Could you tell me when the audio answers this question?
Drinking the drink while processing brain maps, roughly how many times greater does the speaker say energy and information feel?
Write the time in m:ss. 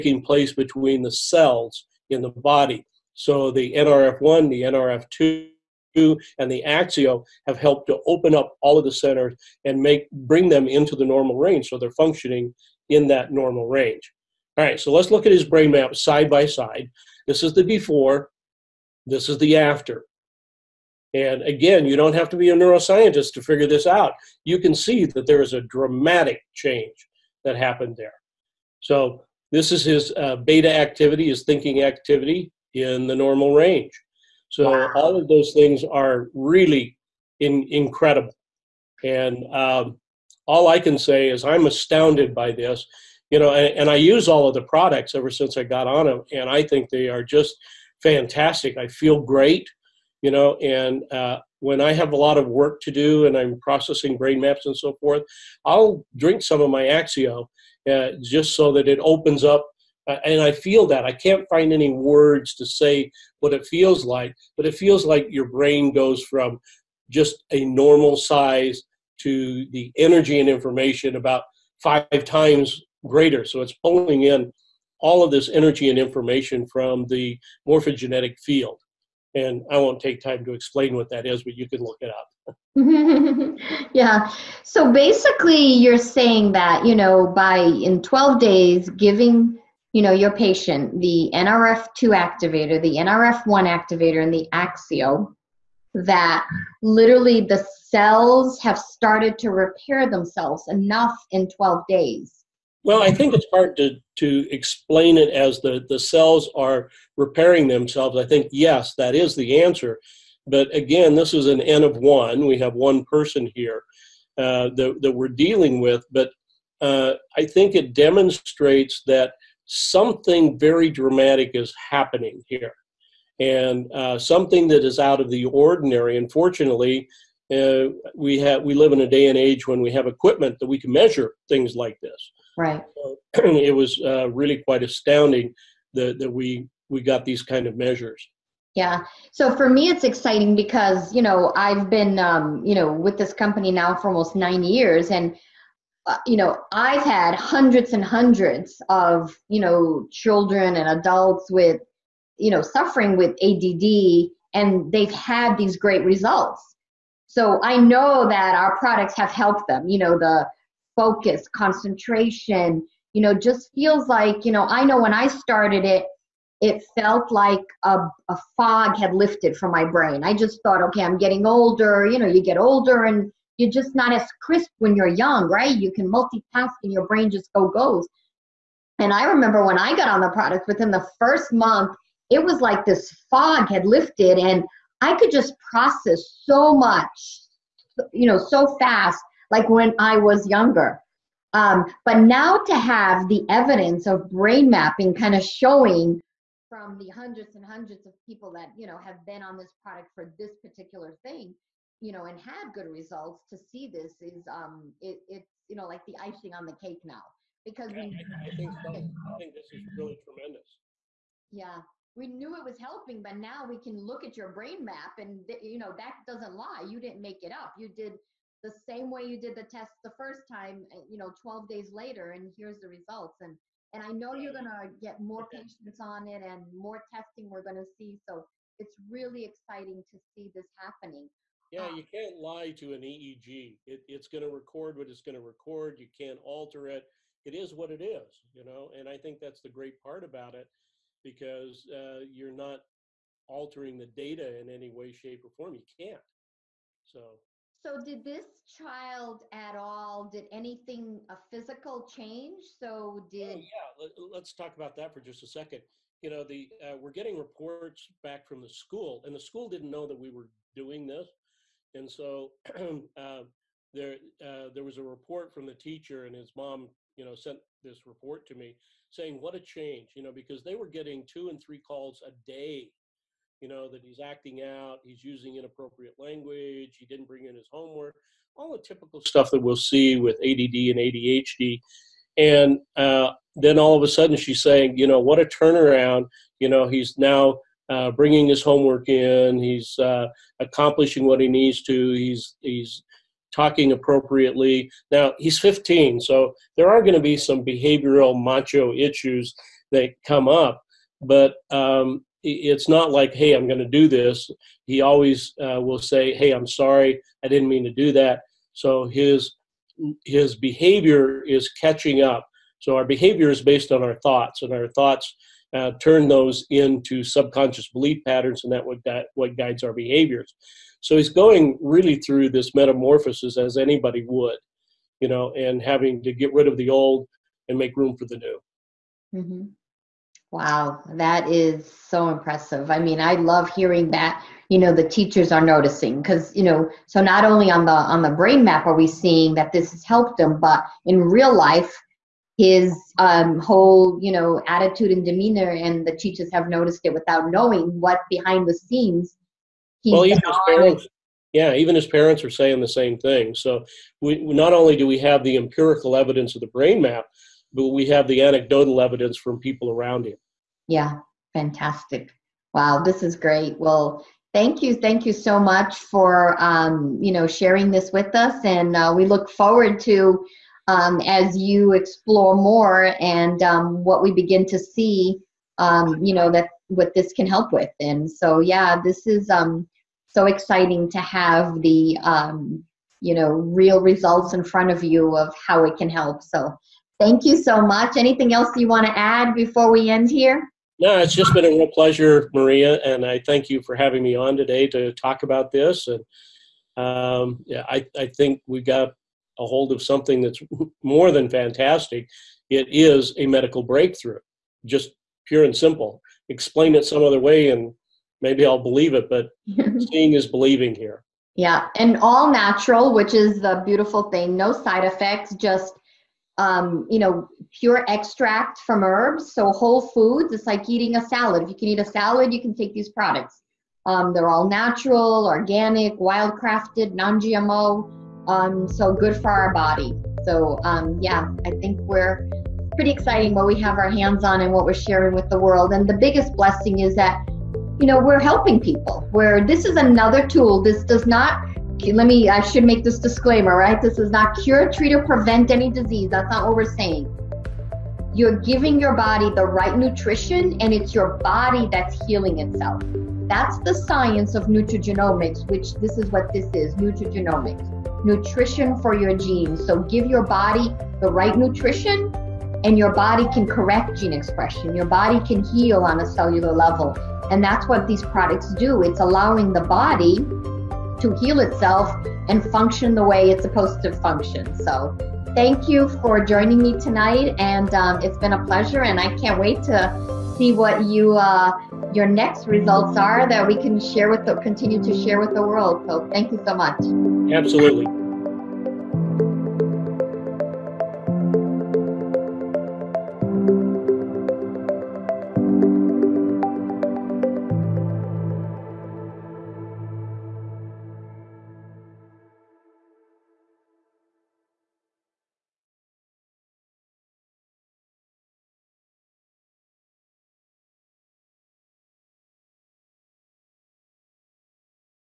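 1:11.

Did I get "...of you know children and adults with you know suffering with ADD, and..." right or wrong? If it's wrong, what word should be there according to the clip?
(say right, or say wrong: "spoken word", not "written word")
right.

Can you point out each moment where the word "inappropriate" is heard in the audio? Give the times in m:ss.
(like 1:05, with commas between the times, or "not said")
4:35.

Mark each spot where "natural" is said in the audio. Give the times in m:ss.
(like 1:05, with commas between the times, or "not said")
6:52, 7:04.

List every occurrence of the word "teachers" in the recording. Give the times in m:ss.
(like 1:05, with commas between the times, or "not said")
4:25, 5:35, 5:46.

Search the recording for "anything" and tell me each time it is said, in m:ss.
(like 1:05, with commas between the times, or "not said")
4:10, 6:28.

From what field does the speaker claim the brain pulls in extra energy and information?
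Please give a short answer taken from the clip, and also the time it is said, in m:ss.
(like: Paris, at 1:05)
morphogenetic field, at 1:17.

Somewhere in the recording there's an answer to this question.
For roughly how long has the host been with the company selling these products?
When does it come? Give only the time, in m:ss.
2:24.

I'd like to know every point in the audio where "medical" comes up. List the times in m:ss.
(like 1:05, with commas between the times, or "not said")
6:43.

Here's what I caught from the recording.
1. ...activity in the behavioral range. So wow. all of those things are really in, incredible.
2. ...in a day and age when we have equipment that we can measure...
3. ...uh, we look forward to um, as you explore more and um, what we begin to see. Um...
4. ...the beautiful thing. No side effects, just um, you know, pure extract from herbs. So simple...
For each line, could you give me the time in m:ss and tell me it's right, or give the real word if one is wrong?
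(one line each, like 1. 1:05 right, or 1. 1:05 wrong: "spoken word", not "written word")
1. 0:31 wrong: "normal", not "behavioral"
2. 2:08 right
3. 6:08 right
4. 6:53 wrong: "whole", not "simple".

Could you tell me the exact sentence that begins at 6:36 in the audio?
And um, yeah, I, I think we got a hold of something that's more than fantastic.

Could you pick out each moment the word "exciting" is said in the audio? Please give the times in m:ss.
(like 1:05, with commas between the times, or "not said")
2:20, 3:49, 6:20, 7:13.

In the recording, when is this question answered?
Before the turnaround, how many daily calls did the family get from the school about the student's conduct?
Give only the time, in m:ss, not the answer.
4:31.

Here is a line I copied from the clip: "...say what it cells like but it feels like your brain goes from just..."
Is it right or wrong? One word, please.
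wrong.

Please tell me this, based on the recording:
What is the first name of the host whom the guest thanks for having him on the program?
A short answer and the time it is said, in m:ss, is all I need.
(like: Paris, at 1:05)
Maria, at 6:32.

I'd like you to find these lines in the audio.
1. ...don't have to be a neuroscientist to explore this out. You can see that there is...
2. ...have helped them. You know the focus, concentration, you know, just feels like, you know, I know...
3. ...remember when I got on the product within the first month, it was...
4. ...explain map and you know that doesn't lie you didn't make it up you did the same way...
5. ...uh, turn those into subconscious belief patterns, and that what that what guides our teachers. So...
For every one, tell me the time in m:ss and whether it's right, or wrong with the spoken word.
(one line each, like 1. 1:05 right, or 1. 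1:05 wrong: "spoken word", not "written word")
1. 0:21 wrong: "figure", not "explore"
2. 2:39 right
3. 2:59 right
4. 3:34 wrong: "brain", not "explain"
5. 5:15 wrong: "behaviors", not "teachers".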